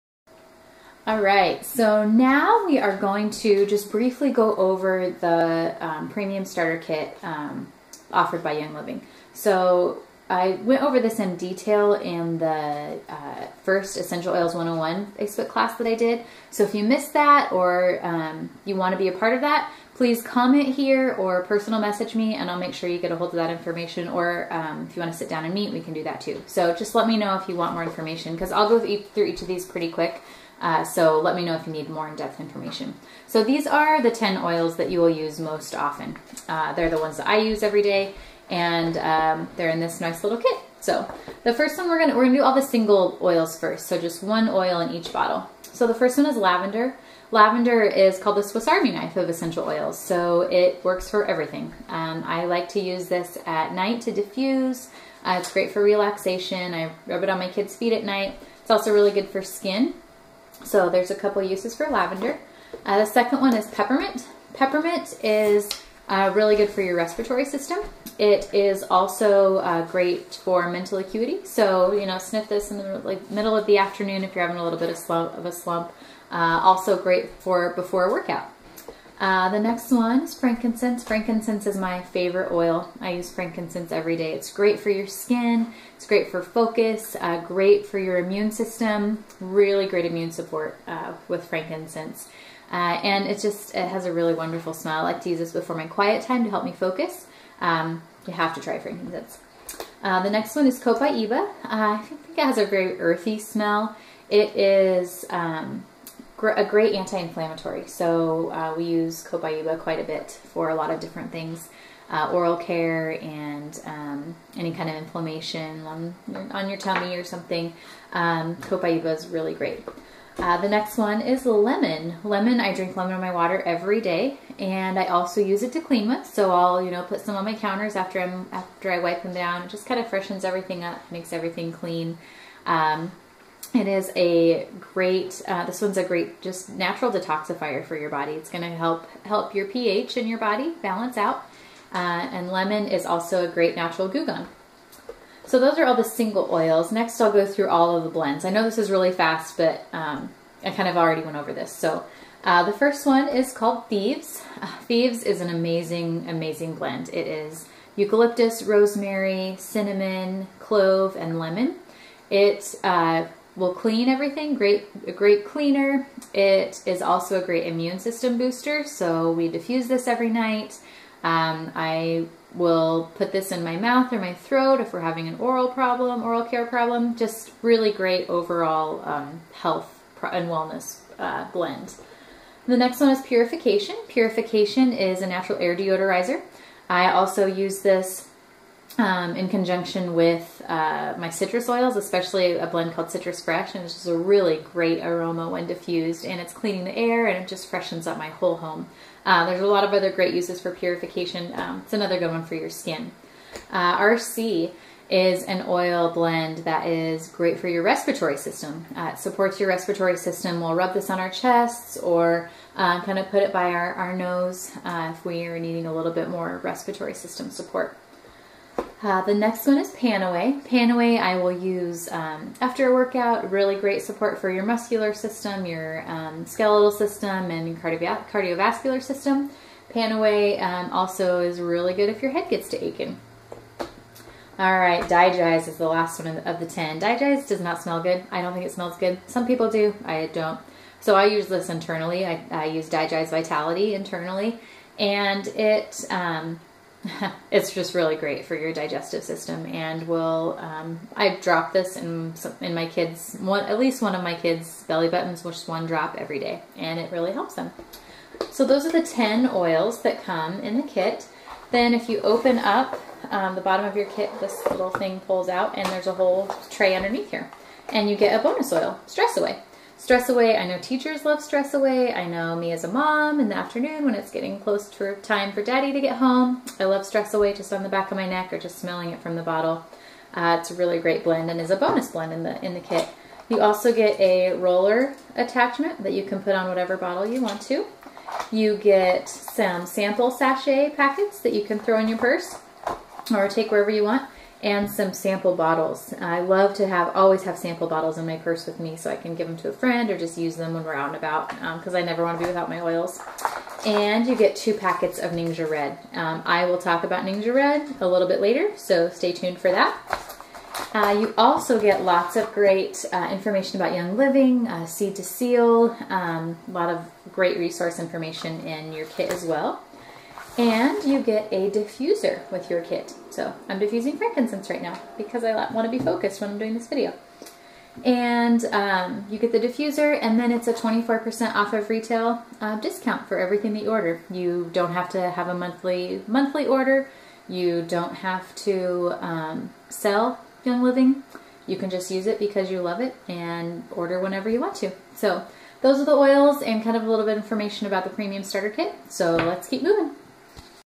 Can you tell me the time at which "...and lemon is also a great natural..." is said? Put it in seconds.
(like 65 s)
141 s.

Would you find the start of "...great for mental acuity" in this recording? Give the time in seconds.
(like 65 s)
69 s.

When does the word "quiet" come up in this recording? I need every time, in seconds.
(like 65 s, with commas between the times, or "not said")
95 s.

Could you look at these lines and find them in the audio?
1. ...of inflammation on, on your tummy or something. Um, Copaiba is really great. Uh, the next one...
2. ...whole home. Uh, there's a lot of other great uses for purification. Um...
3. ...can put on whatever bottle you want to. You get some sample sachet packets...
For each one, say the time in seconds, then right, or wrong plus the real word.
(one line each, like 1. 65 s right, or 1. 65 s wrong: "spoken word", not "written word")
1. 114 s right
2. 198 s right
3. 286 s right.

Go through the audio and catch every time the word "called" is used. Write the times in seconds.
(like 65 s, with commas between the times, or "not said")
48 s, 153 s, 192 s.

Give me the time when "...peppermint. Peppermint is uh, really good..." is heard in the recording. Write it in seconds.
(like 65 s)
63 s.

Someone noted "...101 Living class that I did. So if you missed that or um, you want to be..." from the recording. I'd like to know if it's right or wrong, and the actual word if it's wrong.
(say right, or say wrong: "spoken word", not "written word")
wrong: "Facebook", not "Living".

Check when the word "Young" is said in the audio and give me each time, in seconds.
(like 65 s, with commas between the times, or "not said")
8 s, 313 s, 340 s.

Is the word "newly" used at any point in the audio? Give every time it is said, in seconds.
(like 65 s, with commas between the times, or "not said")
not said.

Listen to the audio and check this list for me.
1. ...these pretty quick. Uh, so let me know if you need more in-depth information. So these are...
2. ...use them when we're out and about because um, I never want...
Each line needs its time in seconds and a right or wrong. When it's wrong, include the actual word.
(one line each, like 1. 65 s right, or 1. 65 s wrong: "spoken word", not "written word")
1. 29 s right
2. 300 s right.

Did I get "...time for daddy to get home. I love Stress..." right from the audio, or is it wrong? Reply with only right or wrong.
right.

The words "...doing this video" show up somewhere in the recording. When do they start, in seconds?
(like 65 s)
326 s.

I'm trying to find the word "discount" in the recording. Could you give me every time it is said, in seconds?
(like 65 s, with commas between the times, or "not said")
332 s.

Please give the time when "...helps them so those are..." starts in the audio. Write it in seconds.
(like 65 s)
257 s.